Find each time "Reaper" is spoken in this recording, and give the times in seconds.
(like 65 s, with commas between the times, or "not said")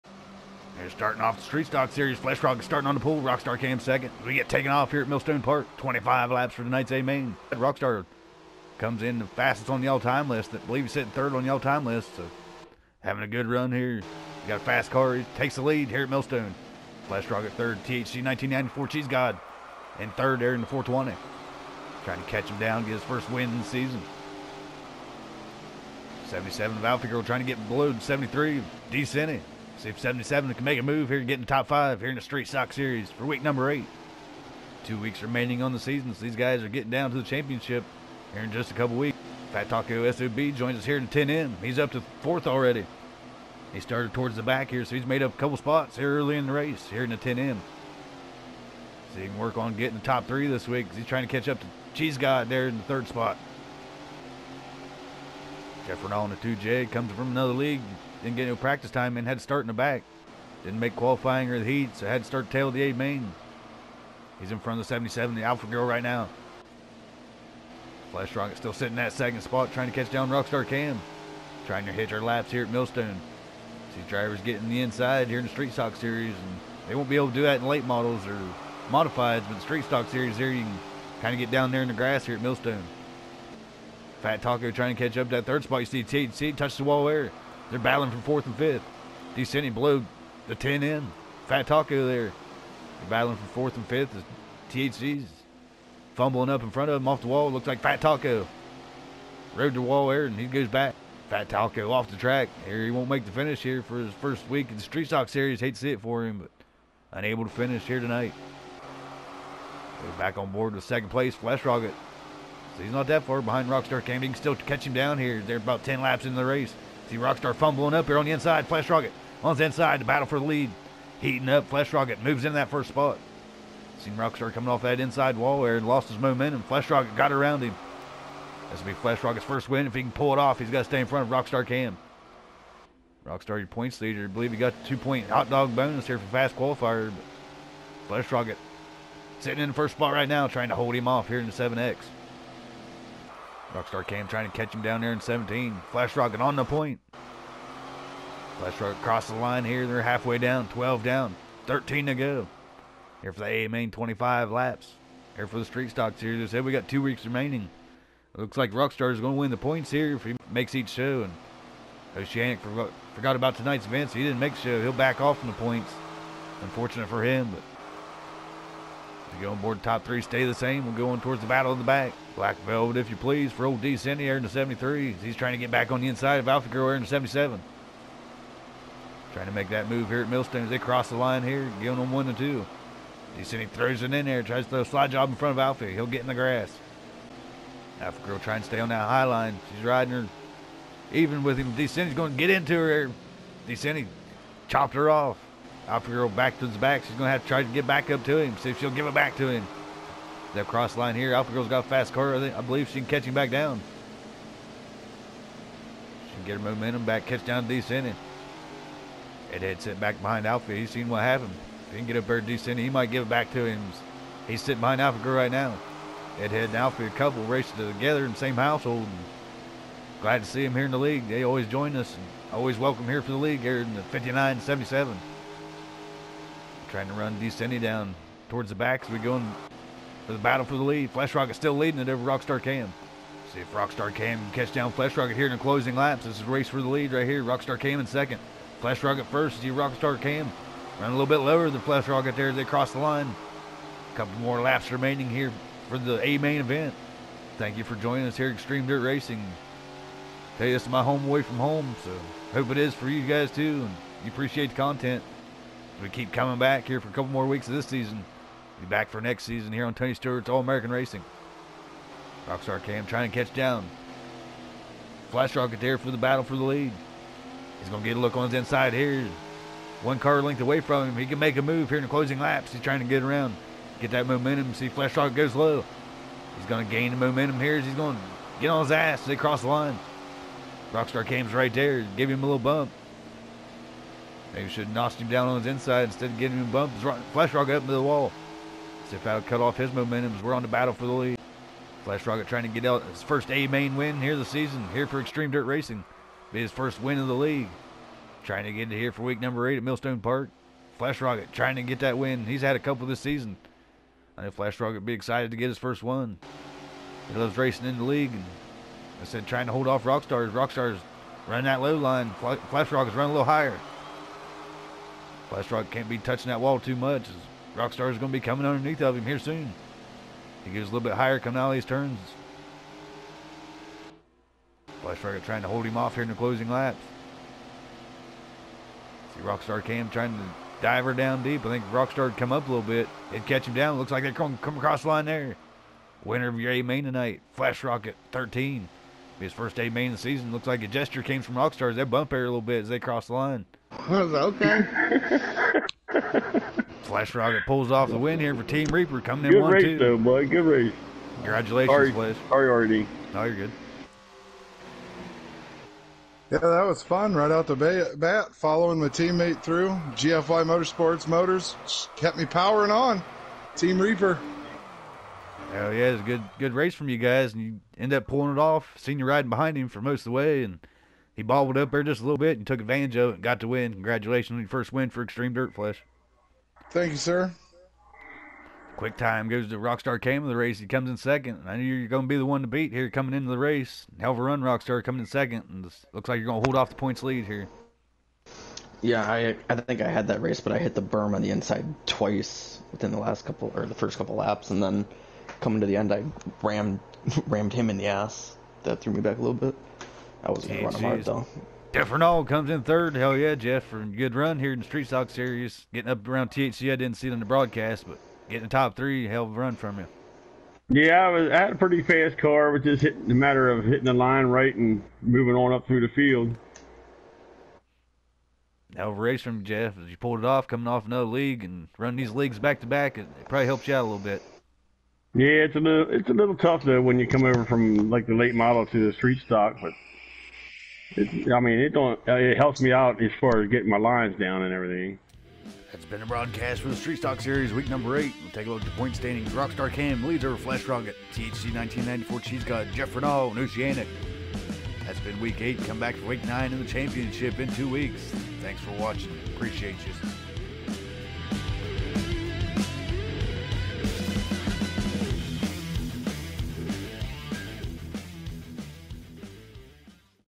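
348 s, 364 s.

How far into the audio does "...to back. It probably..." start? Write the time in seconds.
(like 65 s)
422 s.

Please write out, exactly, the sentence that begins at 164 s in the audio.
He'll back off from the points.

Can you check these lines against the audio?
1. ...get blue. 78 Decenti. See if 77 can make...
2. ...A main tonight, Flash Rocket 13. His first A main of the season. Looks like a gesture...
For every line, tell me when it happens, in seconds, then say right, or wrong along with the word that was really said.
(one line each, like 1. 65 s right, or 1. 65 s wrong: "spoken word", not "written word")
1. 27 s wrong: "73", not "78"
2. 336 s right.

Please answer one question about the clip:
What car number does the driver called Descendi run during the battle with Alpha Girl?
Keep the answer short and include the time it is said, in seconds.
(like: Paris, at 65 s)
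73, at 174 s.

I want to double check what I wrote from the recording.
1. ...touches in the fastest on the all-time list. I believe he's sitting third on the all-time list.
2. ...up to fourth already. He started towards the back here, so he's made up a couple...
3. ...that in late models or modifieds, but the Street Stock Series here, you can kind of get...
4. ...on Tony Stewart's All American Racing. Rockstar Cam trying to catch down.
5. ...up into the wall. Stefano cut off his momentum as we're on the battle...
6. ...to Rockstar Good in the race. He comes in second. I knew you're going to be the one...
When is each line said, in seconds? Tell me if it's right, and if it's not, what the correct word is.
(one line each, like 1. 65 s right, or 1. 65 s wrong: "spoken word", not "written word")
1. 8 s wrong: "comes", not "touches"
2. 41 s right
3. 77 s right
4. 259 s right
5. 287 s right
6. 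379 s wrong: "Cam", not "Good".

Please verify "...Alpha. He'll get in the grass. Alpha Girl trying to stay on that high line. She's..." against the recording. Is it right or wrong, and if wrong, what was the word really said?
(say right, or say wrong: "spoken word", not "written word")
right.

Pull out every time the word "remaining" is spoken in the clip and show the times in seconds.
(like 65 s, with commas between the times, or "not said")
35 s, 157 s, 244 s.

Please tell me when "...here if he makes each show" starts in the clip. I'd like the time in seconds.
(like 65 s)
159 s.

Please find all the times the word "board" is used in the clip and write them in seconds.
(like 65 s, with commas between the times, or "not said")
110 s, 169 s.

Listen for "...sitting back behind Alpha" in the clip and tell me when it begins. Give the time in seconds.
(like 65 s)
209 s.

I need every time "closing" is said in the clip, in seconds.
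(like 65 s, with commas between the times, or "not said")
235 s, 272 s, 326 s.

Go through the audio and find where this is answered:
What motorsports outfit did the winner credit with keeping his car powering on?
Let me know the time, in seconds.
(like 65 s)
360 s.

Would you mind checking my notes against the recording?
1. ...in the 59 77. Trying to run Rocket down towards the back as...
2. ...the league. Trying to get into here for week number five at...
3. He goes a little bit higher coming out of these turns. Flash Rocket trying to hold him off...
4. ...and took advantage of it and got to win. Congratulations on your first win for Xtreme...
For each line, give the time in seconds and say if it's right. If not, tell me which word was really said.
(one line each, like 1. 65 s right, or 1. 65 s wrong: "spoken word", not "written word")
1. 223 s wrong: "Descendi", not "Rocket"
2. 297 s wrong: "eight", not "five"
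3. 320 s right
4. 372 s right.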